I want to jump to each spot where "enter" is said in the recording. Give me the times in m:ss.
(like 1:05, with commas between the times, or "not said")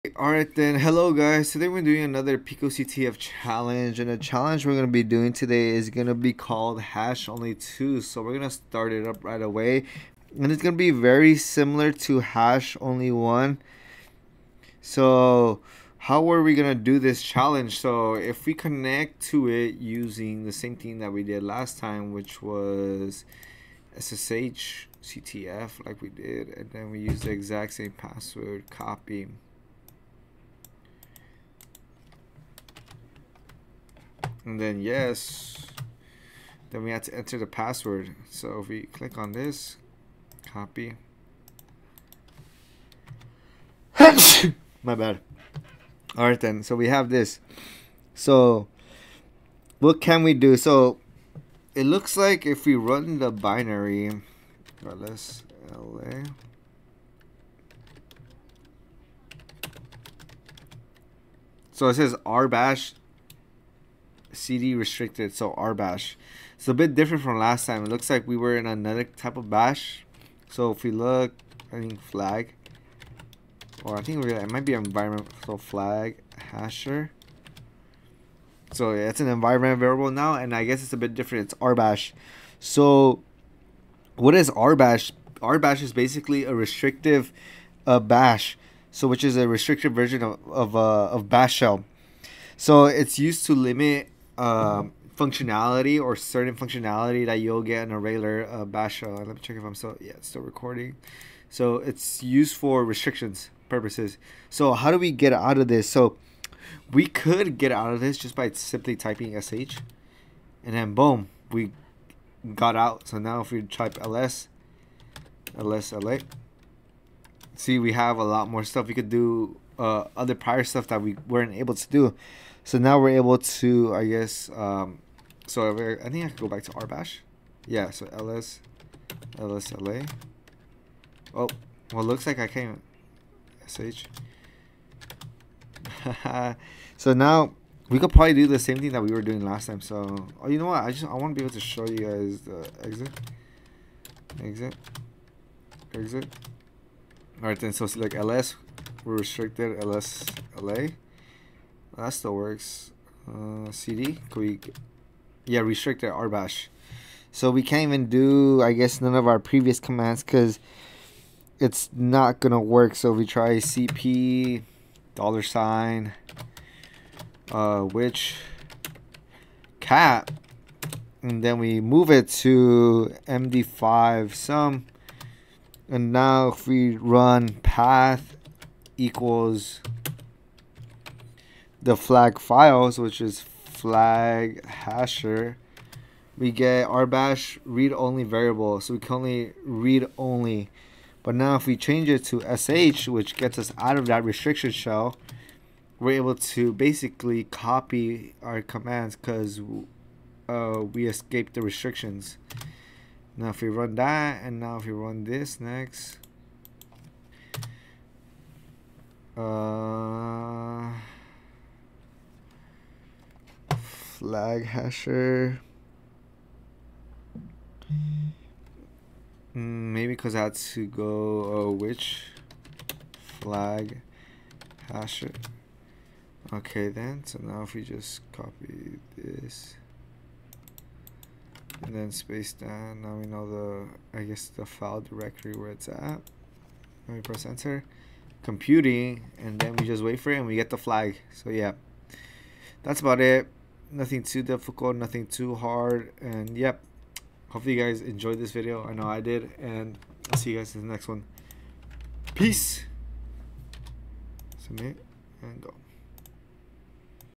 0:37, 3:57.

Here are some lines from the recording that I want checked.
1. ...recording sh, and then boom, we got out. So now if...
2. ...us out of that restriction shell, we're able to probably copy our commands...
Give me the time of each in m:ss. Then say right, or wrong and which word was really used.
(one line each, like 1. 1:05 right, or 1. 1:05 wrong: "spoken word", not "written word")
1. 1:48 wrong: "typing", not "recording"
2. 3:13 wrong: "basically", not "probably".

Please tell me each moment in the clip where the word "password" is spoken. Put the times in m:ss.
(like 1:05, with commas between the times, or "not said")
0:27, 0:37.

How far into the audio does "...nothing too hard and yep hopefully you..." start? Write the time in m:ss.
4:04.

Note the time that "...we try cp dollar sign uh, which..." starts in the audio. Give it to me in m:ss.
2:43.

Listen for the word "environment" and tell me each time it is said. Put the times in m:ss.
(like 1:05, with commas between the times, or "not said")
1:14, 1:19.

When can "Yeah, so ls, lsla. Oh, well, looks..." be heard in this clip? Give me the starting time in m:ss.
2:07.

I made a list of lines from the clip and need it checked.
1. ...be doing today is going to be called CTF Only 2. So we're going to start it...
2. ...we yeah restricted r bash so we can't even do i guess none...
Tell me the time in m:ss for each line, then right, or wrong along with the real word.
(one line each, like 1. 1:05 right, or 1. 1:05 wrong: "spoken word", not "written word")
1. 0:04 wrong: "Hash", not "CTF"
2. 2:34 right.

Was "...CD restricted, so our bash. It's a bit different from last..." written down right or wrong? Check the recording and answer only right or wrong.
right.